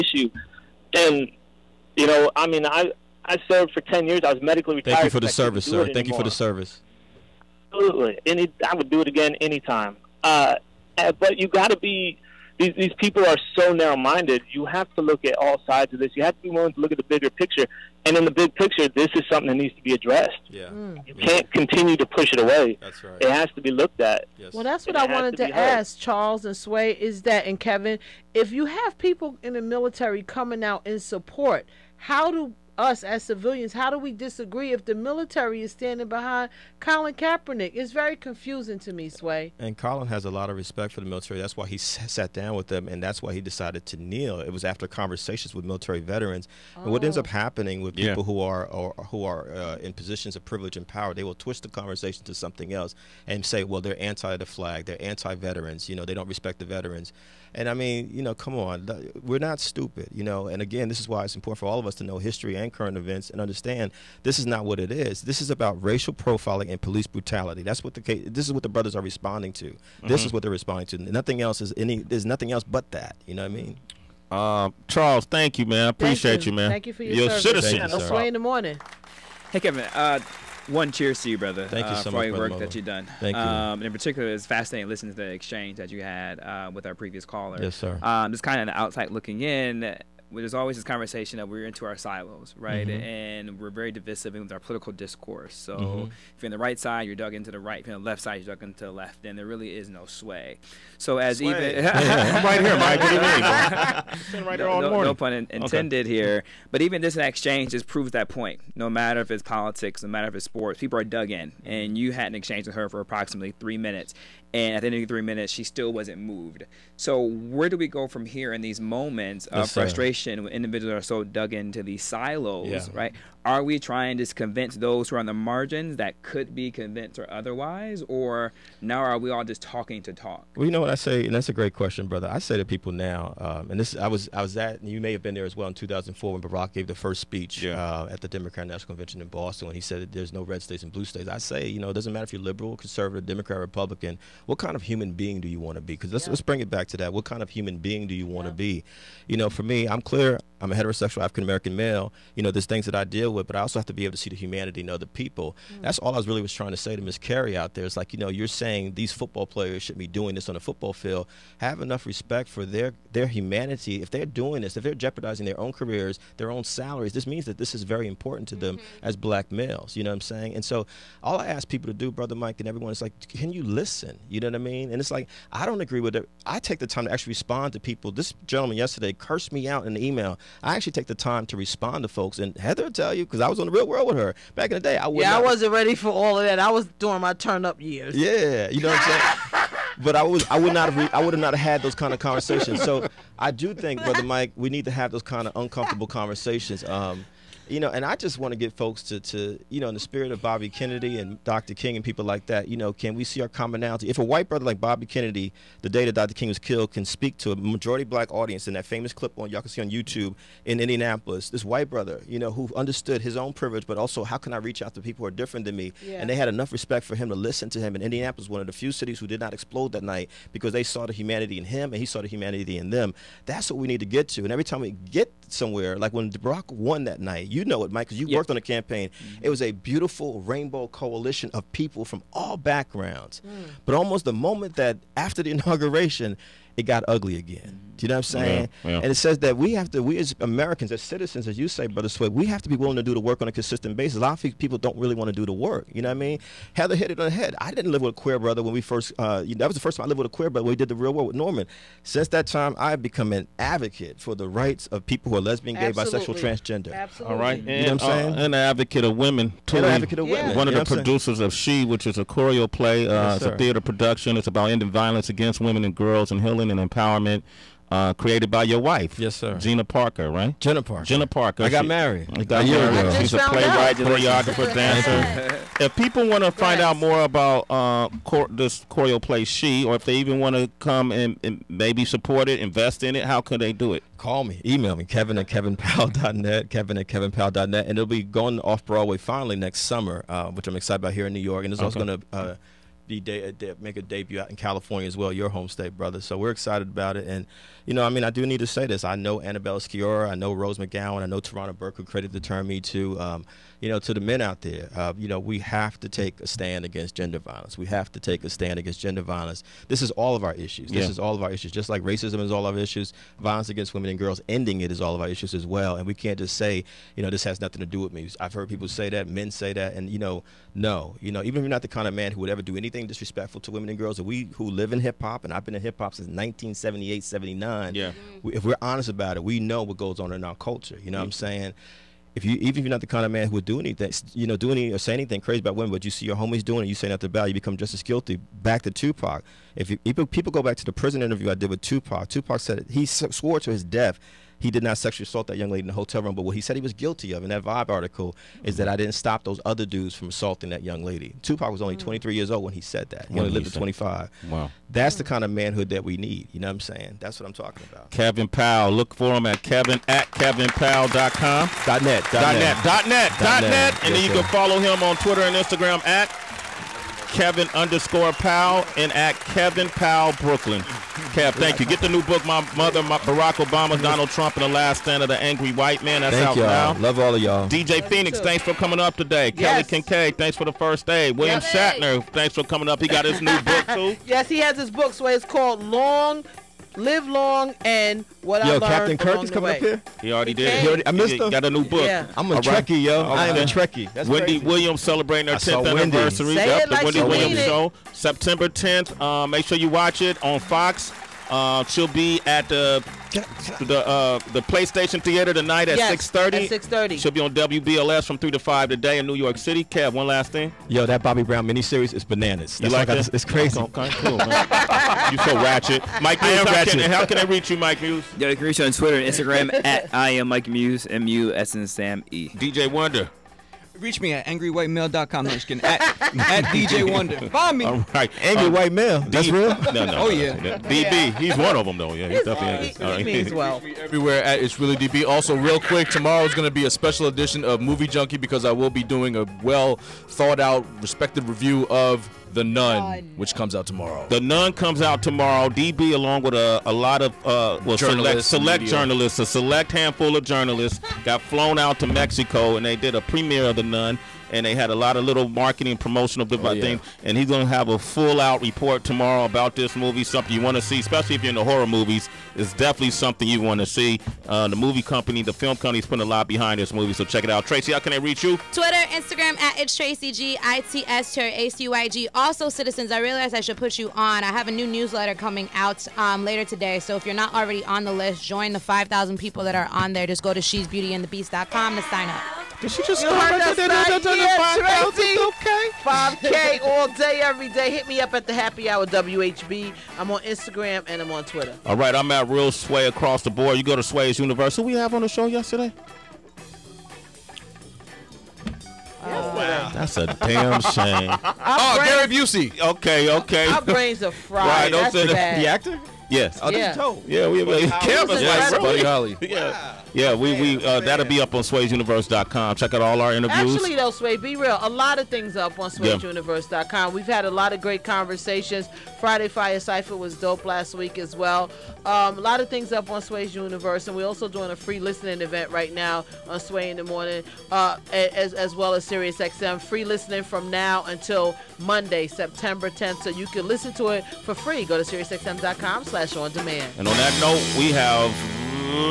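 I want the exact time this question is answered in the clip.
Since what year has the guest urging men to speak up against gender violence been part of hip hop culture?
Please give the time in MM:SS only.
05:26.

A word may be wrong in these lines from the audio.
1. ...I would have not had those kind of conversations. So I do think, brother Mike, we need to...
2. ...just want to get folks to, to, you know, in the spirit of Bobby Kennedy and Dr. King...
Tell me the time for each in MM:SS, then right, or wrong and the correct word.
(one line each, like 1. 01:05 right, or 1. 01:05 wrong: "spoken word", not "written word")
1. 03:11 right
2. 03:18 right.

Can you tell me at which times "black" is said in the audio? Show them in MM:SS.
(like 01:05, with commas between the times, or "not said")
02:49, 03:28.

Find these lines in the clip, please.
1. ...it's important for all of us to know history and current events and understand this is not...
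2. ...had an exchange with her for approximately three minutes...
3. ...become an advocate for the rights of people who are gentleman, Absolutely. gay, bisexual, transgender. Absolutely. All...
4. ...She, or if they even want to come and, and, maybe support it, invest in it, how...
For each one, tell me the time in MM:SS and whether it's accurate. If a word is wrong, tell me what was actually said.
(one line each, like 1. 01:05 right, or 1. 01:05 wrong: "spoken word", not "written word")
1. 01:01 right
2. 01:52 right
3. 04:13 wrong: "lesbian", not "gentleman"
4. 04:39 right.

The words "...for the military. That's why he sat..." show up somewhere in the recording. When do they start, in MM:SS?
00:40.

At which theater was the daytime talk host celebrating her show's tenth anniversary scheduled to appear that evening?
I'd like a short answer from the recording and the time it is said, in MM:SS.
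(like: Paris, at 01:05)
PlayStation Theater, at 06:44.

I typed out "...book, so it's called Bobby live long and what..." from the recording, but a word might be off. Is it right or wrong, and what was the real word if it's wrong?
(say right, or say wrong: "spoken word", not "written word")
wrong: "Long", not "Bobby".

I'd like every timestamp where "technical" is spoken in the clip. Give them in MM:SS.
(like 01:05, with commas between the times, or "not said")
not said.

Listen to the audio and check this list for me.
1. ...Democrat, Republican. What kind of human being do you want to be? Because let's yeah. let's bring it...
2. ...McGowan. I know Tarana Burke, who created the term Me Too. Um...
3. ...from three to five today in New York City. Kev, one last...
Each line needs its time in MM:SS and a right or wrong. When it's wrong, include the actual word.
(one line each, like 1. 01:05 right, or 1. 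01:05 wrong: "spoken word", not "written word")
1. 02:23 right
2. 05:00 right
3. 06:48 right.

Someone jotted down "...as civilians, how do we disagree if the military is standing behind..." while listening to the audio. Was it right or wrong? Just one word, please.
right.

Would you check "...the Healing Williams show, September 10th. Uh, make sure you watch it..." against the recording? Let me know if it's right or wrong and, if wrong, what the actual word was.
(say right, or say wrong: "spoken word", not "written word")
wrong: "Wendy", not "Healing".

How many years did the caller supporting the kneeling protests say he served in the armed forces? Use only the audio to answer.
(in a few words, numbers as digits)
10.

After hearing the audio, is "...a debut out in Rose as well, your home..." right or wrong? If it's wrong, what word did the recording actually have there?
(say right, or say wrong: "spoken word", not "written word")
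wrong: "California", not "Rose".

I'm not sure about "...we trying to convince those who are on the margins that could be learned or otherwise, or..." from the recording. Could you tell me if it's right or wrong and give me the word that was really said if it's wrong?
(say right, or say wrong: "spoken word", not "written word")
wrong: "convinced", not "learned".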